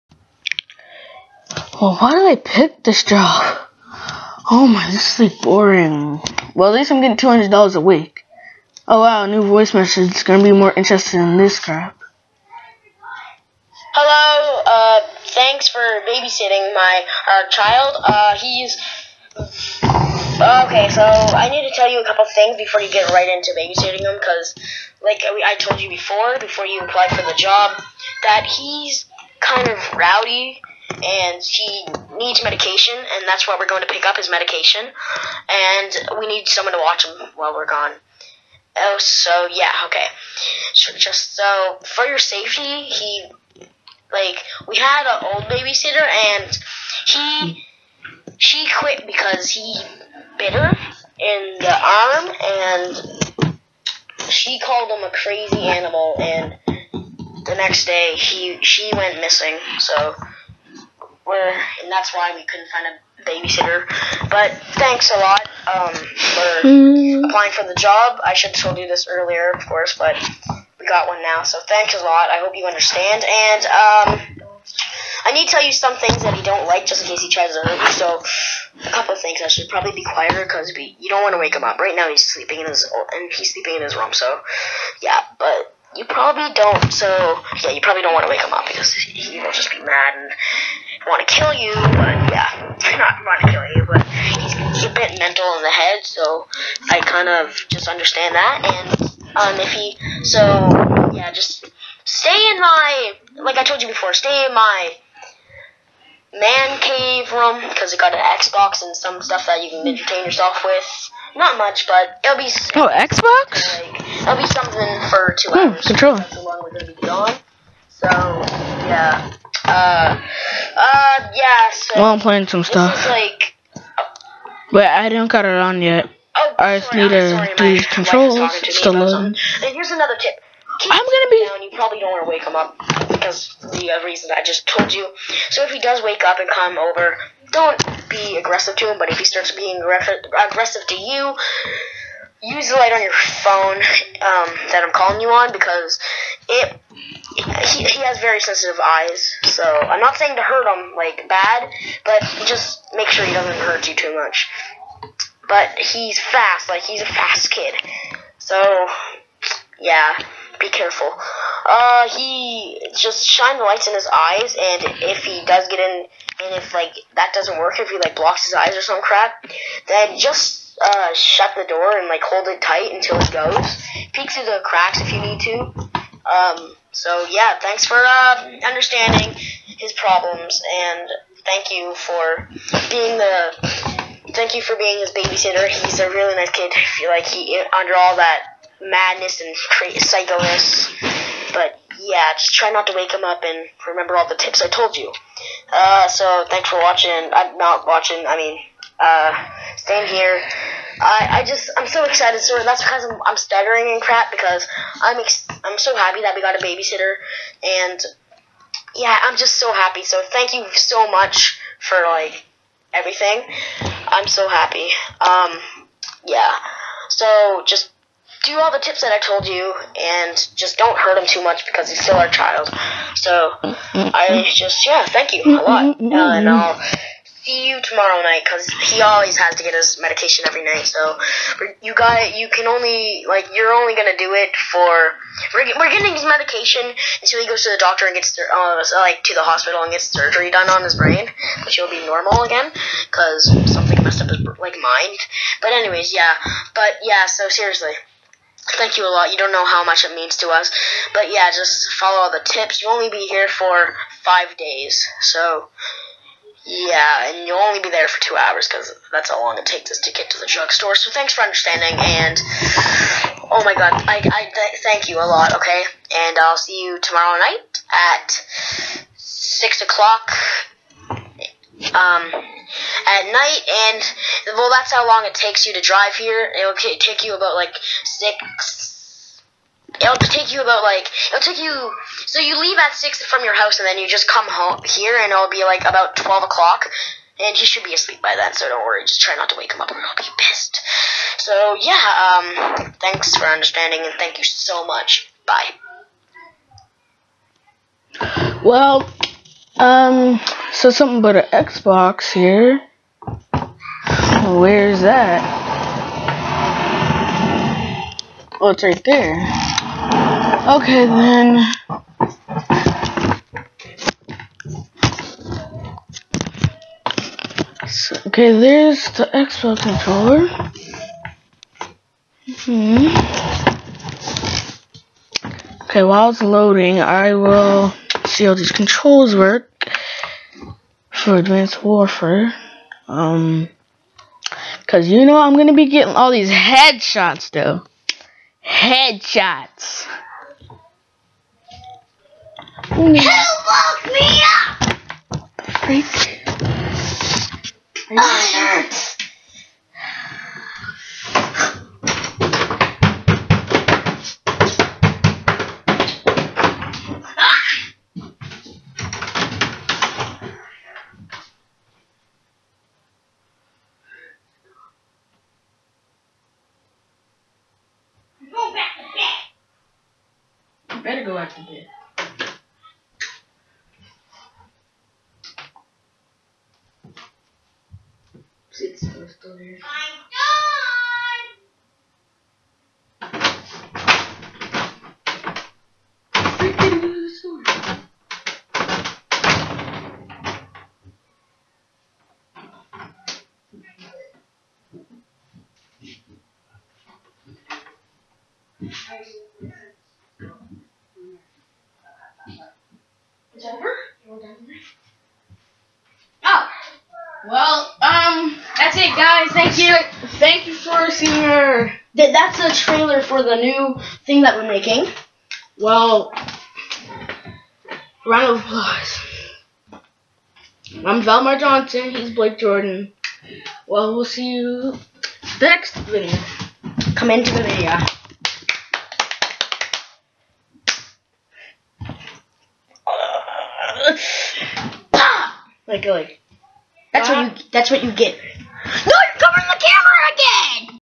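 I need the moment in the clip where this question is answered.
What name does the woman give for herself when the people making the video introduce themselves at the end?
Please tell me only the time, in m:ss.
7:01.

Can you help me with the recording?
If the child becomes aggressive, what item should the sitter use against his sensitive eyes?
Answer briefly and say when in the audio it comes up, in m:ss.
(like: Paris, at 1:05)
the light on your phone, at 2:22.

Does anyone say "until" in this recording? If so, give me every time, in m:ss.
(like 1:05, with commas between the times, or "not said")
2:52, 3:57.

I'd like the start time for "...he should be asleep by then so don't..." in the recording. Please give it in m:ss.
4:47.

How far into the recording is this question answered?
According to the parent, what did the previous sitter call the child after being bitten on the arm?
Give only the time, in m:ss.
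0:55.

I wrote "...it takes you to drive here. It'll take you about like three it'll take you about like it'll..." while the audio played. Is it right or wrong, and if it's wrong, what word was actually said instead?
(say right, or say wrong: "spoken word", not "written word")
wrong: "six", not "three".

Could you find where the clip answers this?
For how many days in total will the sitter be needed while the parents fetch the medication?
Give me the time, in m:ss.
4:14.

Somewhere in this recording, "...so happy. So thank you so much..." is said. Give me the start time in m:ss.
3:29.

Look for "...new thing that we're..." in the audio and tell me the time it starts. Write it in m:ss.
6:53.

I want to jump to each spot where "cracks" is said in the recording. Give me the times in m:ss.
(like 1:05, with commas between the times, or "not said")
2:54.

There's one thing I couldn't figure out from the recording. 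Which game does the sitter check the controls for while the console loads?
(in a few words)
Advanced Warfare.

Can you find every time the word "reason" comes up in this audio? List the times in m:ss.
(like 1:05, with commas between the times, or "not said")
2:14.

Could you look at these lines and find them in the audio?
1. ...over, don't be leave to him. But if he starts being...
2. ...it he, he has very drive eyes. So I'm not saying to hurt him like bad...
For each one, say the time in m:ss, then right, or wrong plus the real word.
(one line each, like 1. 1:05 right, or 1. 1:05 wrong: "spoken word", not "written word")
1. 2:16 wrong: "aggressive", not "leave"
2. 2:27 wrong: "sensitive", not "drive".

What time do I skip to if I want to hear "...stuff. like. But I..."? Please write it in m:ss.
2:02.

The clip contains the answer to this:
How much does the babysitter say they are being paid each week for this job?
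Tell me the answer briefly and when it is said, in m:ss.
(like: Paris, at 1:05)
$200, at 0:07.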